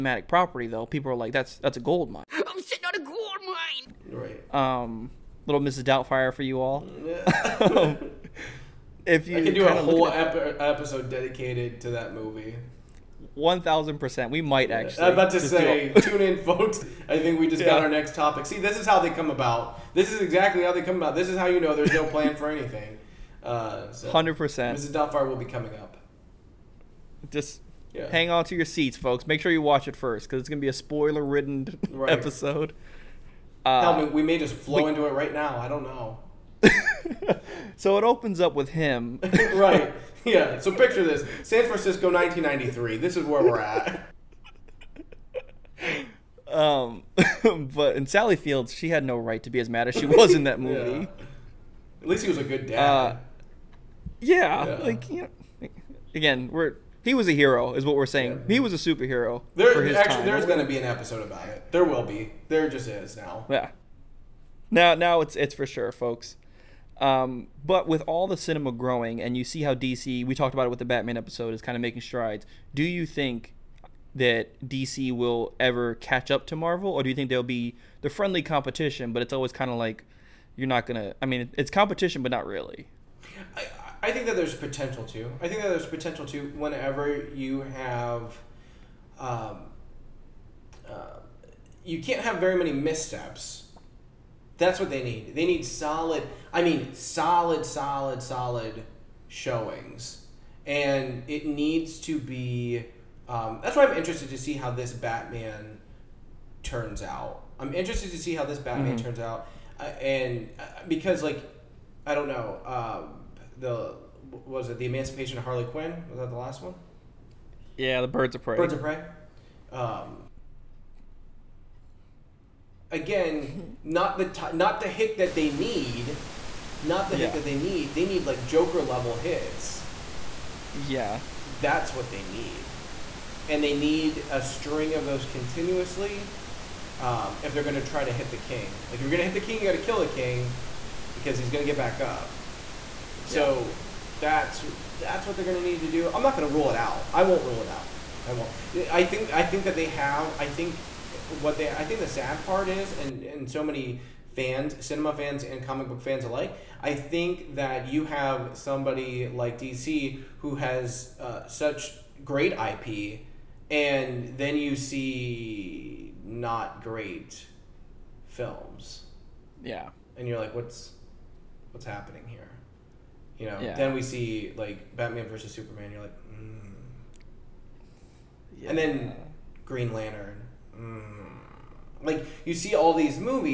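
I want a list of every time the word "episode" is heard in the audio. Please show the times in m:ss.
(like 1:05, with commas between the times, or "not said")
0:10, 0:32, 1:00, 1:11.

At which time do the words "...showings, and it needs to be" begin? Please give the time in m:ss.
1:39.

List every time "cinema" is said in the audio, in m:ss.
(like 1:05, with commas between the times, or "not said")
1:08, 2:34.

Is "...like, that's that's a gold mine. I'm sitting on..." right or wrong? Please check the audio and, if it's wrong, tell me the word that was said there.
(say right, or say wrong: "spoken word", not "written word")
right.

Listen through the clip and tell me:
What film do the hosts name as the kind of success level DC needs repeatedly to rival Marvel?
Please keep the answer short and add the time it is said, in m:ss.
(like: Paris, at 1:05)
Joker, at 2:08.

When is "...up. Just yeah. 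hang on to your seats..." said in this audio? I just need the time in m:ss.
0:25.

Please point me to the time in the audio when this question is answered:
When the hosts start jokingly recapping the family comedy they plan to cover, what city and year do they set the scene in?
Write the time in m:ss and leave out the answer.
0:41.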